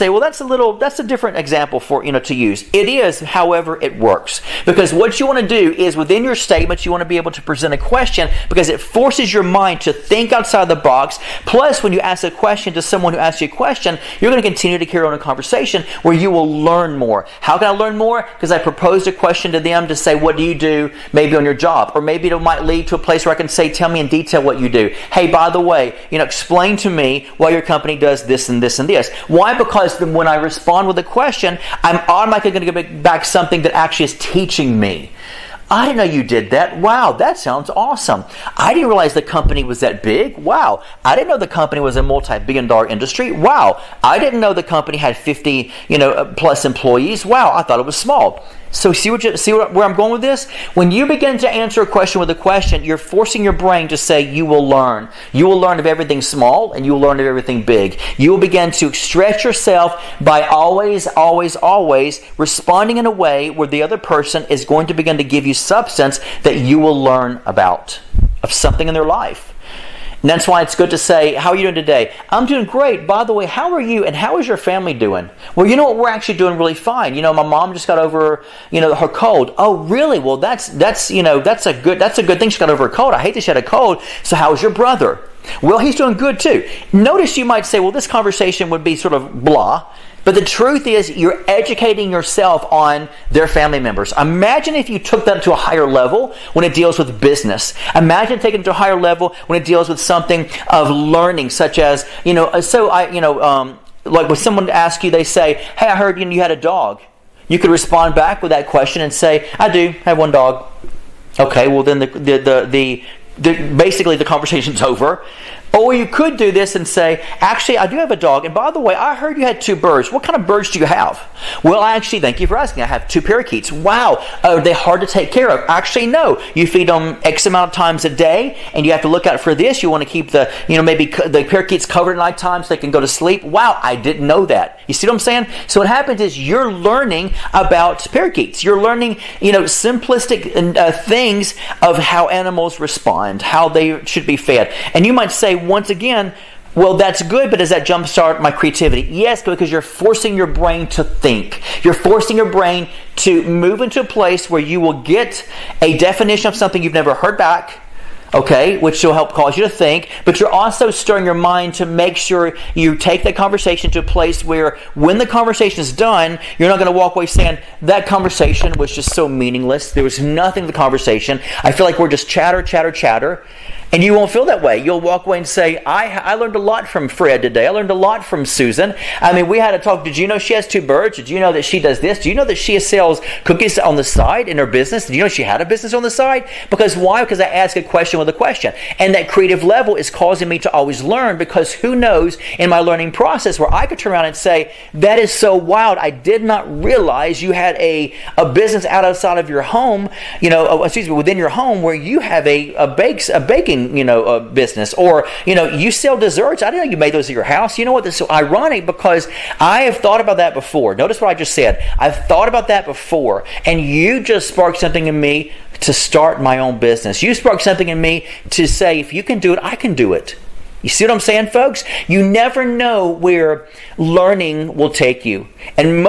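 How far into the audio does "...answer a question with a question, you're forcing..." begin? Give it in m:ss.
0:51.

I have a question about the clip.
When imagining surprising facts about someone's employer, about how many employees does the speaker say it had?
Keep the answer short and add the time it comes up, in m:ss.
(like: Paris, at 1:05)
50, at 0:45.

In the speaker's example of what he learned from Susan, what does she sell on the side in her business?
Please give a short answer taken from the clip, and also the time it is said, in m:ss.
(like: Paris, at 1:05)
cookies, at 3:03.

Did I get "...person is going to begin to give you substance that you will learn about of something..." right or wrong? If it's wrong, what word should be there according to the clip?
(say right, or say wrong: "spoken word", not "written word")
right.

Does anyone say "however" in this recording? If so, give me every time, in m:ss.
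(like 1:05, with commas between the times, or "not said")
0:03.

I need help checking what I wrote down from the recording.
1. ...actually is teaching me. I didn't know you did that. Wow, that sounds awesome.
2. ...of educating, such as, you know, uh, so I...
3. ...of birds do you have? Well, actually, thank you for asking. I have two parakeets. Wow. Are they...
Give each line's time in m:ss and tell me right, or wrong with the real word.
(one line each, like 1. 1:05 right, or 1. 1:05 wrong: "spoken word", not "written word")
1. 0:33 right
2. 1:40 wrong: "learning", not "educating"
3. 2:00 right.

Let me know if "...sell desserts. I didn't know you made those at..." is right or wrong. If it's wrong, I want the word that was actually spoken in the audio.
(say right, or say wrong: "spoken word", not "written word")
right.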